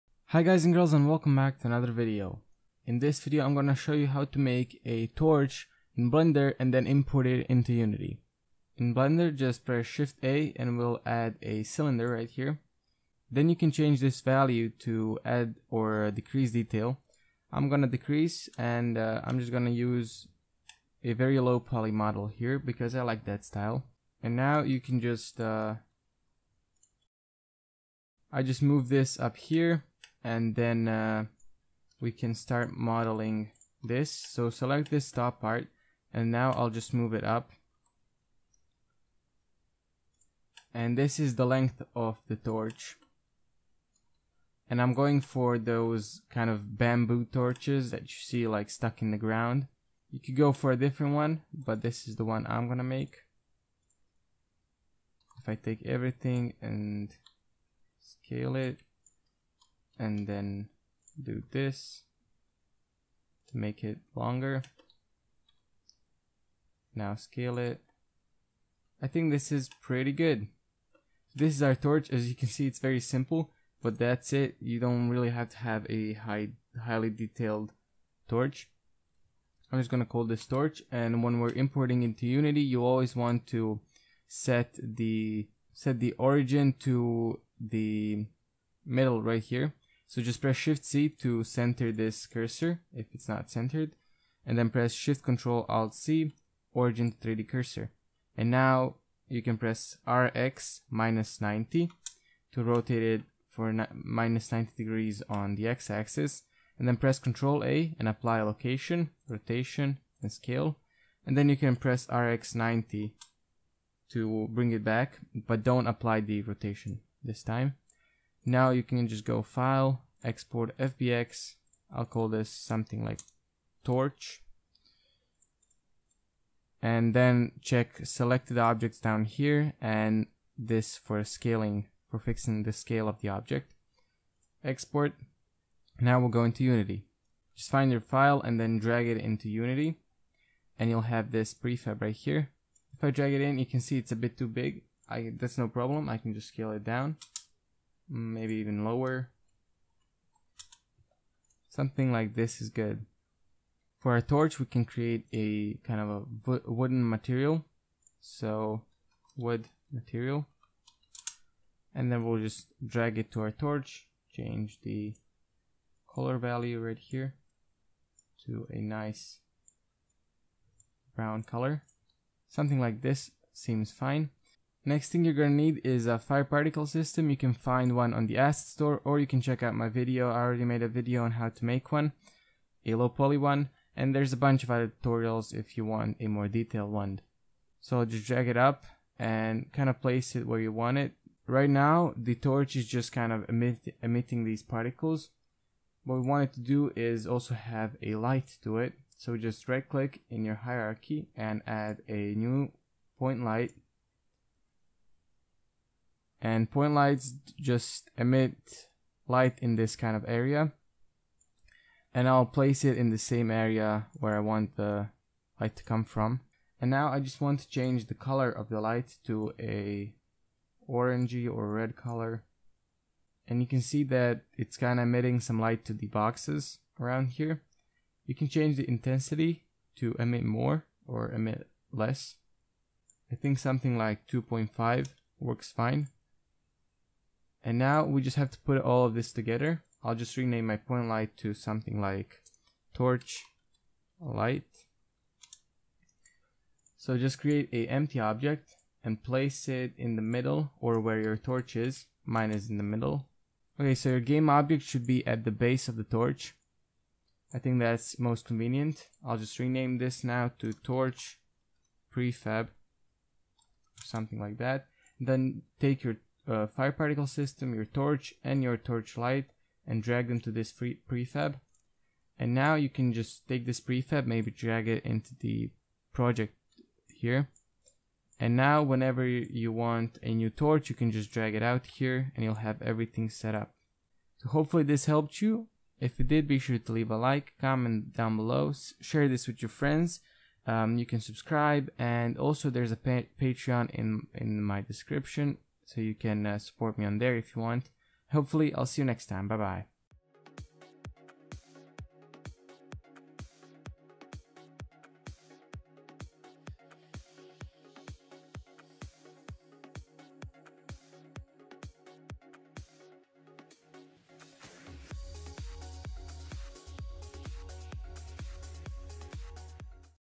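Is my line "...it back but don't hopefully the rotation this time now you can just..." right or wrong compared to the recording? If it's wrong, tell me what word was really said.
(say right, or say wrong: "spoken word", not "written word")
wrong: "apply", not "hopefully".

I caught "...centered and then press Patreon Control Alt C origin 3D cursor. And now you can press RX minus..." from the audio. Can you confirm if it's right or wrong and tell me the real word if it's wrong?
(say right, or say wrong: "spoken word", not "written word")
wrong: "Shift", not "Patreon".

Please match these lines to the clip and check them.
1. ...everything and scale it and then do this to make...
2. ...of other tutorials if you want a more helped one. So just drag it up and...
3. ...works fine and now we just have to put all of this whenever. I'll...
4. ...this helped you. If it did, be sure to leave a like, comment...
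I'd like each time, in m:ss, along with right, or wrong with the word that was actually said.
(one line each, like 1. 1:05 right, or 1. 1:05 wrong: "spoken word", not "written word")
1. 0:55 right
2. 3:04 wrong: "detailed", not "helped"
3. 3:55 wrong: "together", not "whenever"
4. 4:44 right.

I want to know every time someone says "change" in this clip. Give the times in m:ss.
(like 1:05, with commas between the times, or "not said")
0:13, 2:44, 3:37, 3:48.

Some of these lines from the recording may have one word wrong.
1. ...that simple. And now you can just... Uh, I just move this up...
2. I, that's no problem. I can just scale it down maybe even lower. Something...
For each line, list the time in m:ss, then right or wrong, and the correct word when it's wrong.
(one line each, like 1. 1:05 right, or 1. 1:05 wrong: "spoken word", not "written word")
1. 0:23 wrong: "style", not "simple"
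2. 2:25 right.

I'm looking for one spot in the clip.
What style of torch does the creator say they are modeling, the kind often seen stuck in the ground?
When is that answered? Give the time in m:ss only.
0:46.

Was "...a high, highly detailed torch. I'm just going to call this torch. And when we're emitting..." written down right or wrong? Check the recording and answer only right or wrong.
wrong.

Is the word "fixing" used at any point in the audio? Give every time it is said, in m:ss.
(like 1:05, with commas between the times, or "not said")
2:12.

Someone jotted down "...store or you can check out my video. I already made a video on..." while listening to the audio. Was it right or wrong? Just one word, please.
right.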